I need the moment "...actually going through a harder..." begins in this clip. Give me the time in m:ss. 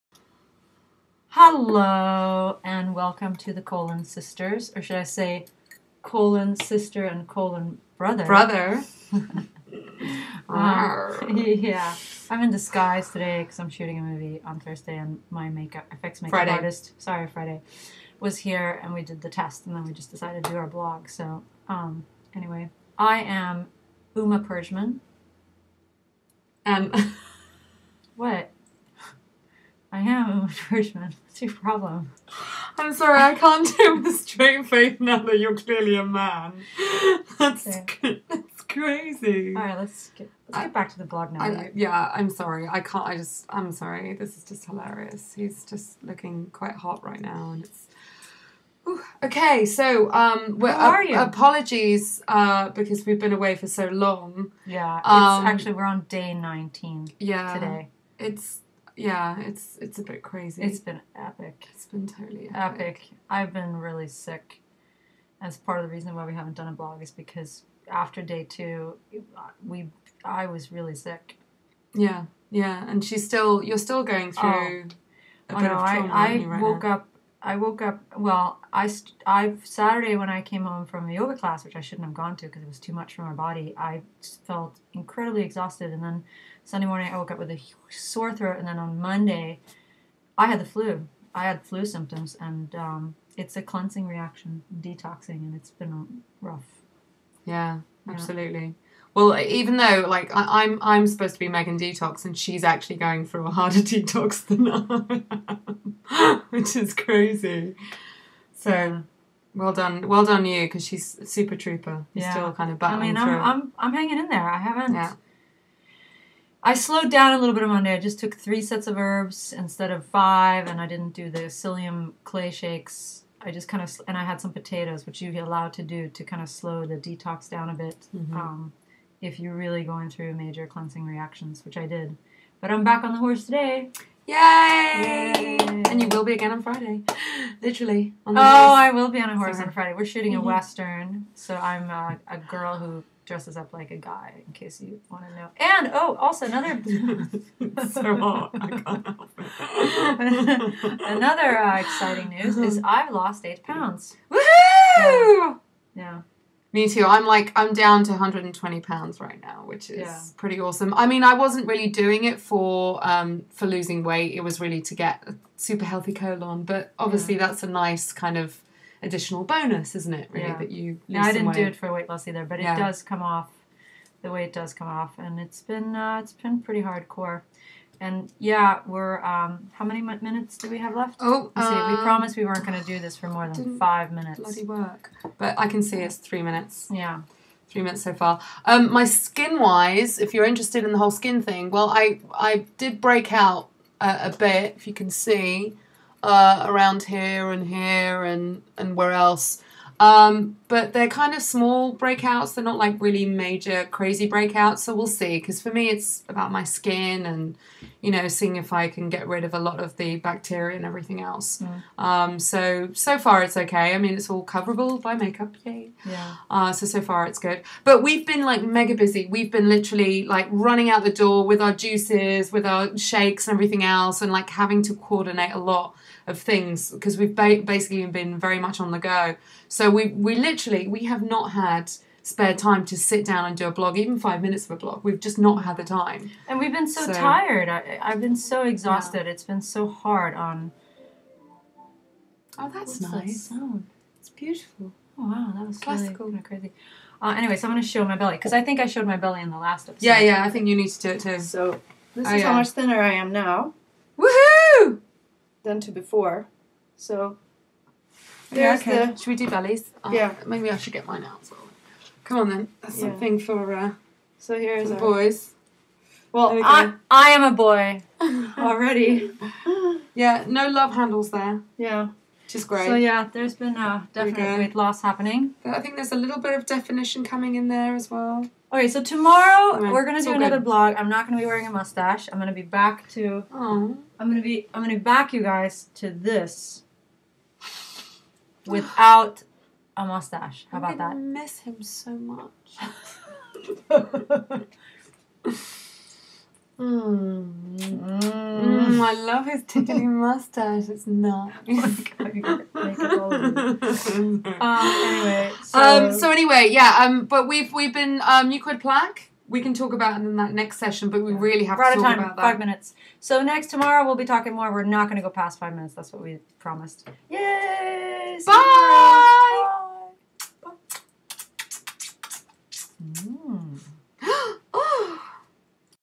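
1:42.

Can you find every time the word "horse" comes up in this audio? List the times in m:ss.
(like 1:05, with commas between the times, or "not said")
2:13, 2:19.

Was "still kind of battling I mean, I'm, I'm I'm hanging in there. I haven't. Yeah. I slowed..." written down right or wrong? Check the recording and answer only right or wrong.
right.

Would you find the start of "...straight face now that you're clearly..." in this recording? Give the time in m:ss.
0:34.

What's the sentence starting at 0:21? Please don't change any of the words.
So um, anyway, I am Uma Perjman.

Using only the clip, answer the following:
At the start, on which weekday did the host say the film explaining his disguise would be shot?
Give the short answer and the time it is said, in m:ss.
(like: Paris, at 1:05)
Thursday, at 0:14.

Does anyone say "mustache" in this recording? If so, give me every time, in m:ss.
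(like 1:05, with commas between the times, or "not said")
4:41, 4:50, 5:00.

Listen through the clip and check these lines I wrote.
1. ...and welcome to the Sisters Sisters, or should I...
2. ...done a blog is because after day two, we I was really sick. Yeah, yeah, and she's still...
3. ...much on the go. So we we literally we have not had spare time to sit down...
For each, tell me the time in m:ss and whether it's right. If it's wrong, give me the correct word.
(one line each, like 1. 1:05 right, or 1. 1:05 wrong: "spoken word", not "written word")
1. 0:02 wrong: "Colon", not "Sisters"
2. 1:06 right
3. 3:48 right.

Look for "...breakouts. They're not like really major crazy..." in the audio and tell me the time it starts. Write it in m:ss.
3:21.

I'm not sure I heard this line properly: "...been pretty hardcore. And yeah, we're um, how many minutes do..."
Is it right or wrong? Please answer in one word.
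right.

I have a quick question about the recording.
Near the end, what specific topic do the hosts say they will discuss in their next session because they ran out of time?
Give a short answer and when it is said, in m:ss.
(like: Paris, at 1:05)
Mucoid plaque, at 5:08.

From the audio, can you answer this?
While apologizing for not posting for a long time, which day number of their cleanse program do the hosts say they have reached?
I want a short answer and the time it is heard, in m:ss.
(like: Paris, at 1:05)
19, at 0:56.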